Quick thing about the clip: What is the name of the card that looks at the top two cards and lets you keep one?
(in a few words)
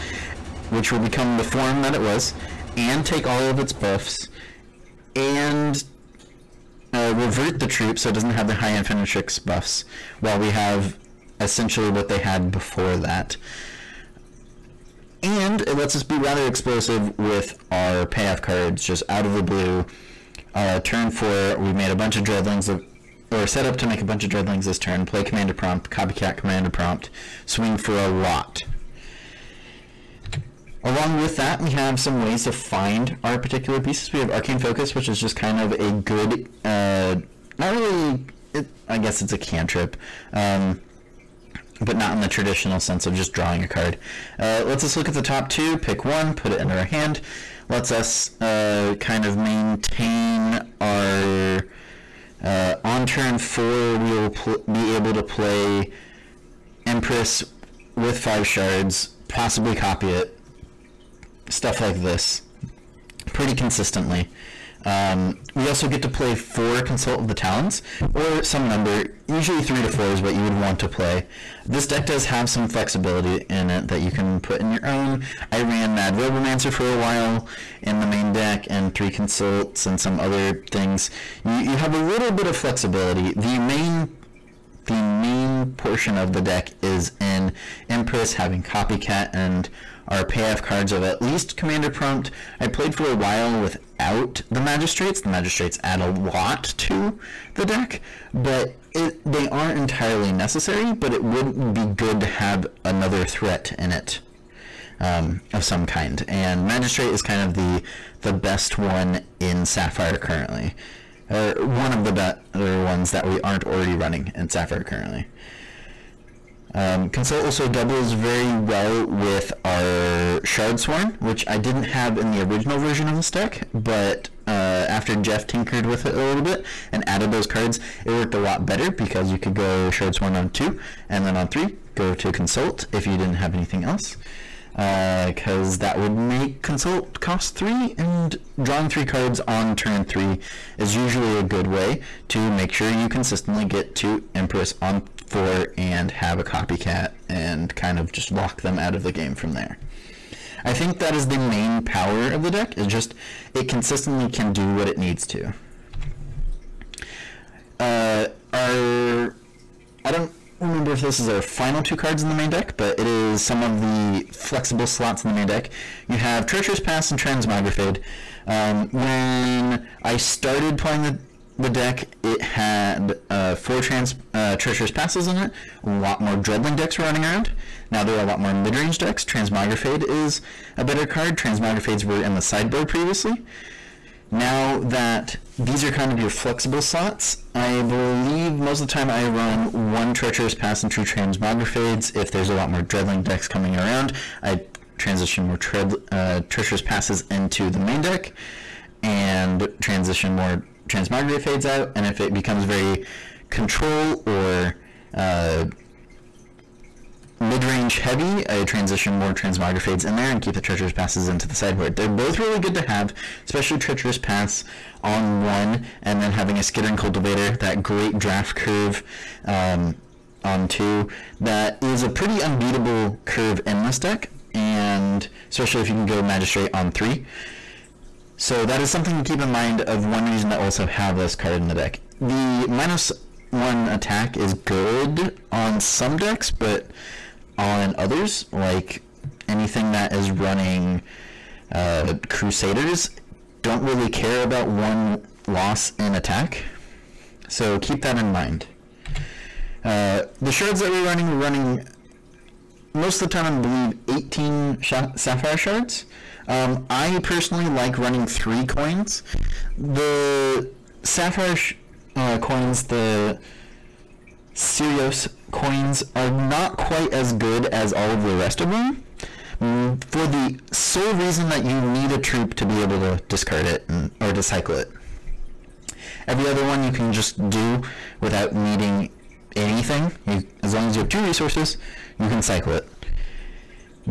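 Arcane Focus.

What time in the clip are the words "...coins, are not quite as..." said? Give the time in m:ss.
4:25.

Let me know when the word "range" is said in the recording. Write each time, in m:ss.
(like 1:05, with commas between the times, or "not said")
2:58, 3:27.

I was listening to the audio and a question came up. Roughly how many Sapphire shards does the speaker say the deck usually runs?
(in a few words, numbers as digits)
18.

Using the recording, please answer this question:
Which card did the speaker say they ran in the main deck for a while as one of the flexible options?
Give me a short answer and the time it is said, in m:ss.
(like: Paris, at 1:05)
Mad Robomancer, at 1:15.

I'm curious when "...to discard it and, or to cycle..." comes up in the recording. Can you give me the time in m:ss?
4:32.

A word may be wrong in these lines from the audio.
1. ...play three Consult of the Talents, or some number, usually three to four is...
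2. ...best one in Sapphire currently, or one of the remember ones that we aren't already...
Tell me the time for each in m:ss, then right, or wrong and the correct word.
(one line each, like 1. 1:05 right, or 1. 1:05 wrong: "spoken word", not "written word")
1. 1:06 wrong: "four", not "three"
2. 1:48 wrong: "better", not "remember".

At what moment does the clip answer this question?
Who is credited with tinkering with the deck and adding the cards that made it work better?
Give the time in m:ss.
2:05.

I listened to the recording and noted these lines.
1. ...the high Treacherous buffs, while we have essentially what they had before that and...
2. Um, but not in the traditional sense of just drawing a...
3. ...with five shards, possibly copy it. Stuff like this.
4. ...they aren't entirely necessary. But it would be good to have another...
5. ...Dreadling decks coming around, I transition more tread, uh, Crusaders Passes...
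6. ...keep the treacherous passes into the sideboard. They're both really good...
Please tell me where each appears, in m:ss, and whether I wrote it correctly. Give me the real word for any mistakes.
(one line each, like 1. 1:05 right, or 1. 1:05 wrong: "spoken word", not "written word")
1. 0:08 wrong: "Infinitrix", not "Treacherous"
2. 0:40 right
3. 0:57 right
4. 1:39 right
5. 3:12 wrong: "Treacherous", not "Crusaders"
6. 3:30 right.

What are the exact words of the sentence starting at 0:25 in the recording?
Play commander prompt, copycat commander prompt, swing for a lot.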